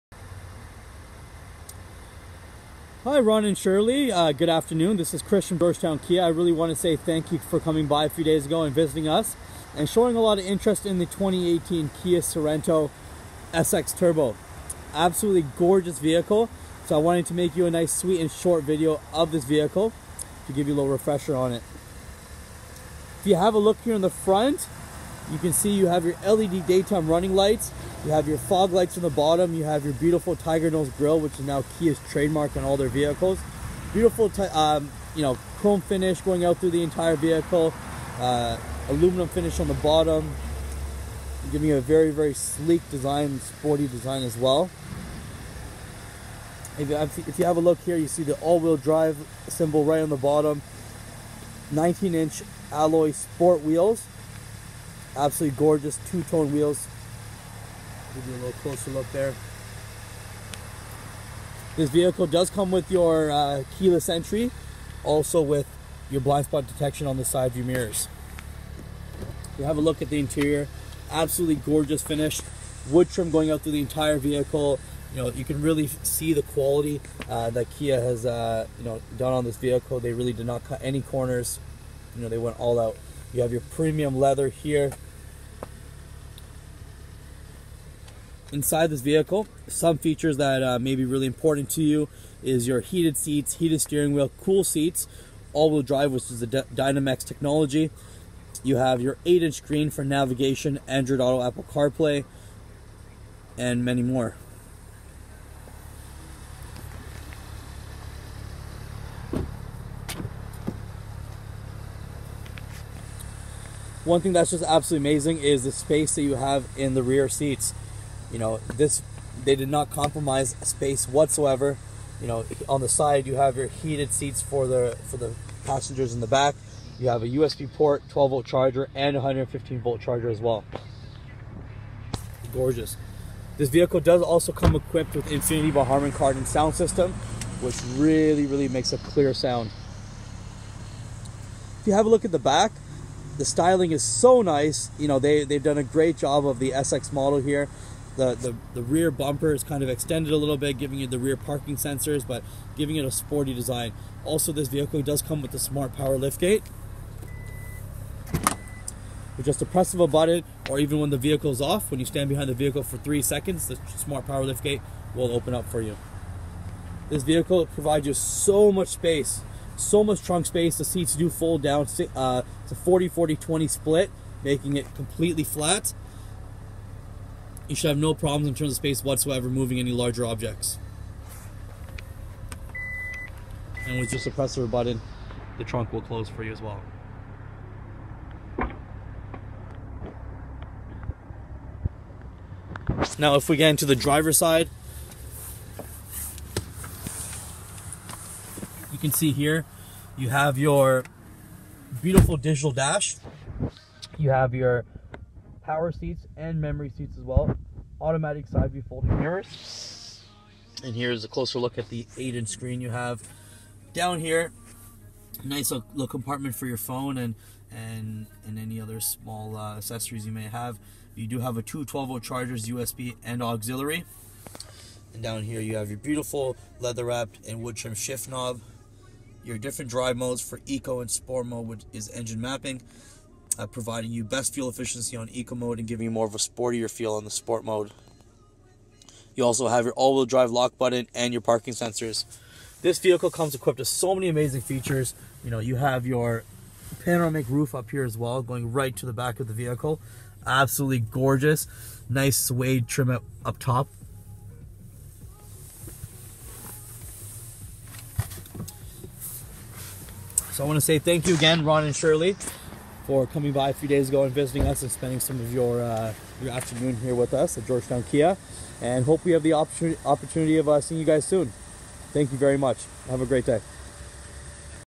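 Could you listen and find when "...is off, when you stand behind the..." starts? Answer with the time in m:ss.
2:41.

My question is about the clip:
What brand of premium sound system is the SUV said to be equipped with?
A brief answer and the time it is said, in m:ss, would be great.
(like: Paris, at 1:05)
Harman Kardon, at 2:15.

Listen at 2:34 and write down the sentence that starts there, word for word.
Also, this vehicle does come with the smart power liftgate.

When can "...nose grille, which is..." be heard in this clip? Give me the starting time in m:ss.
0:30.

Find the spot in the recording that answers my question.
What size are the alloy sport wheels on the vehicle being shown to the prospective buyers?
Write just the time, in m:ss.
0:51.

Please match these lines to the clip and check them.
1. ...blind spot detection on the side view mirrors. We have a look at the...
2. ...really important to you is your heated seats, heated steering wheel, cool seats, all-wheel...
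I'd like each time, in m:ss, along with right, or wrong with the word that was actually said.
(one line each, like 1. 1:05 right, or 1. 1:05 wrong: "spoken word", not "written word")
1. 1:06 right
2. 1:31 right.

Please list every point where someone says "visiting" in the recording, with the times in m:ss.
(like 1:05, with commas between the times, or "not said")
0:08, 4:24.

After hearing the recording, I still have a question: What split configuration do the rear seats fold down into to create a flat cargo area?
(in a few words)
40/40/20.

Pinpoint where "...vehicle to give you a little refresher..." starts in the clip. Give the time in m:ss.
0:19.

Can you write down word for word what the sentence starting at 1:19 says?
They really did not cut any corners.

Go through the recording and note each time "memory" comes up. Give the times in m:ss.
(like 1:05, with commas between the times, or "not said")
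3:26.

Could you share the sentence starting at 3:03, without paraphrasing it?
And with just a press of a button, the trunk will close for you as well.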